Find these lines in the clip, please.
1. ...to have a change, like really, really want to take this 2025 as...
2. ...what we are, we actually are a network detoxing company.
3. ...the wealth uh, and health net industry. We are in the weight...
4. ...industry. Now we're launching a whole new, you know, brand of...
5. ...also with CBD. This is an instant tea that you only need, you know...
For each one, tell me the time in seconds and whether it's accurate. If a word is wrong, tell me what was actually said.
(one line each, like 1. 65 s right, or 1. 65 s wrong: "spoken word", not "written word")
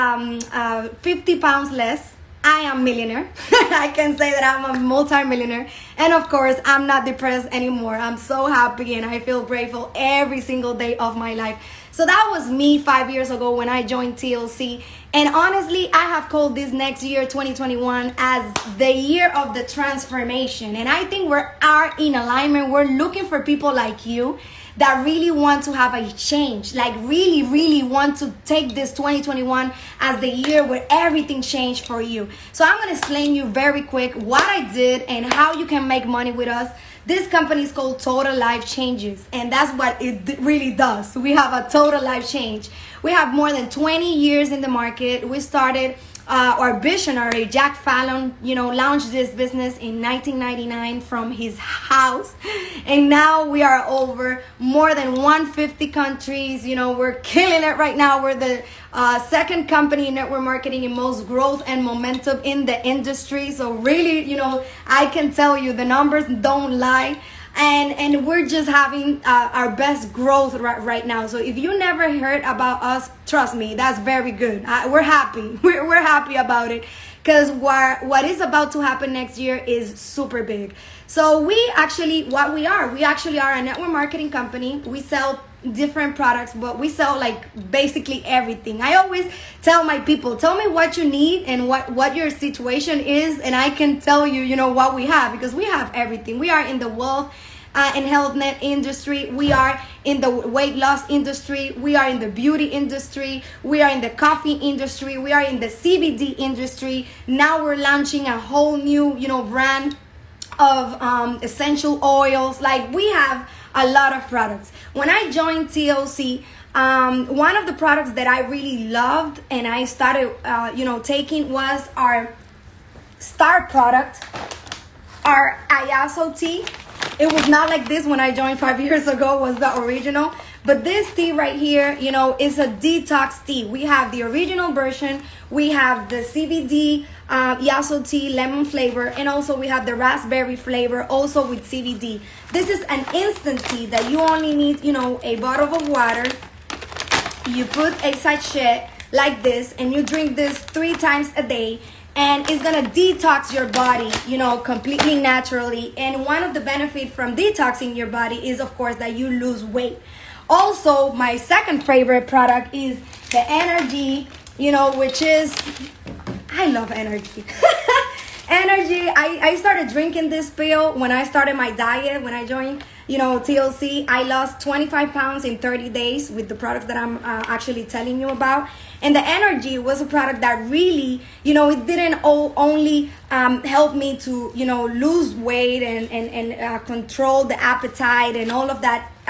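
1. 25 s wrong: "2021", not "2025"
2. 82 s wrong: "marketing", not "detoxing"
3. 96 s right
4. 106 s right
5. 141 s right.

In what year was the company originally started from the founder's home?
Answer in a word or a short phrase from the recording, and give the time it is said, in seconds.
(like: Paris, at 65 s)
1999, at 50 s.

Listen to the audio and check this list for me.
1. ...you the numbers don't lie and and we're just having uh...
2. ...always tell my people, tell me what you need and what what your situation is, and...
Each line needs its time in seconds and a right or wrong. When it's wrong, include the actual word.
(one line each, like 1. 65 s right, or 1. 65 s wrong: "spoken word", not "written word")
1. 65 s right
2. 88 s right.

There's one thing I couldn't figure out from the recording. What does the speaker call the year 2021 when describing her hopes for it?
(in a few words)
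the year of the transformation.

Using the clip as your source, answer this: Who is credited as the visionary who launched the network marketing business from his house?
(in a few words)
Jack Fallon.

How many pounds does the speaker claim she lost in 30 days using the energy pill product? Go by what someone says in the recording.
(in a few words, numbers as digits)
25.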